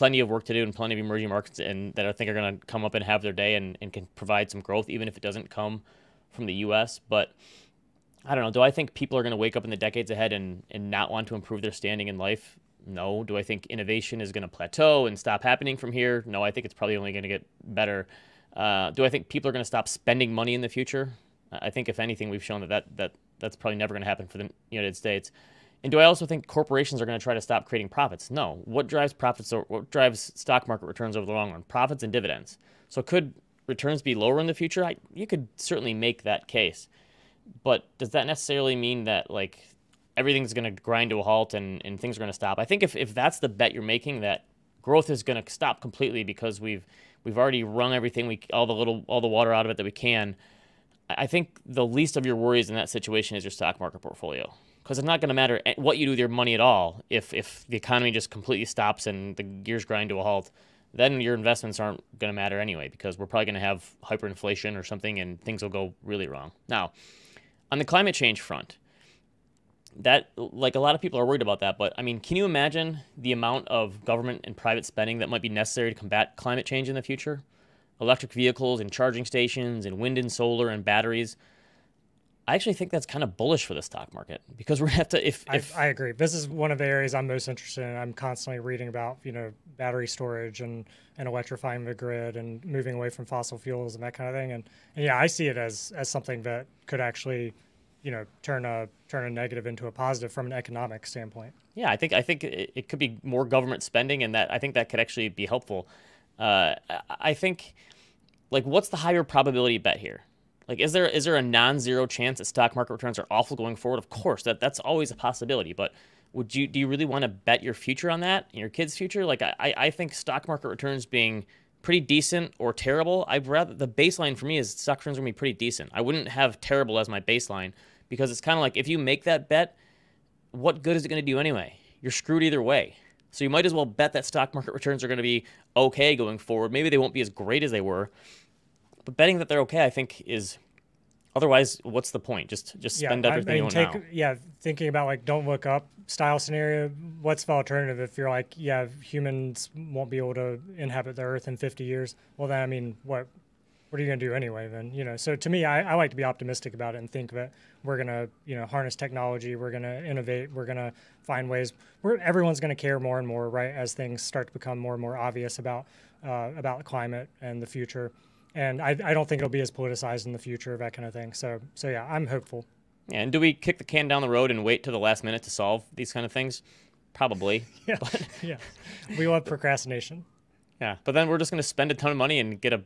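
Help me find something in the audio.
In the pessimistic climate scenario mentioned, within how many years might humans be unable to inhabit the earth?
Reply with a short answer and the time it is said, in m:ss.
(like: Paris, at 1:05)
50, at 2:31.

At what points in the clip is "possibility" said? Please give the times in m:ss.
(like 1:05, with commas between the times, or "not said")
1:55.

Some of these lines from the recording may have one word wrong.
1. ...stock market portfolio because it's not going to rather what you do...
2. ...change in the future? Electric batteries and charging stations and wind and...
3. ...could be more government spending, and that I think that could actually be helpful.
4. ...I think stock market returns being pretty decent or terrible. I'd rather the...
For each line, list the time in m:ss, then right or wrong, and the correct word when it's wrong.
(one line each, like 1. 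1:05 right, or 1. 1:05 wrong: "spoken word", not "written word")
1. 0:53 wrong: "matter", not "rather"
2. 1:16 wrong: "vehicles", not "batteries"
3. 1:42 right
4. 1:59 right.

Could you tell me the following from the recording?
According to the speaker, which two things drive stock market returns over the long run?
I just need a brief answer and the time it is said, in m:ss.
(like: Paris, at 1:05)
Profits and dividends, at 0:31.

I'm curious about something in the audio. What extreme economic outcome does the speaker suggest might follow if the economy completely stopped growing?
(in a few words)
Hyperinflation.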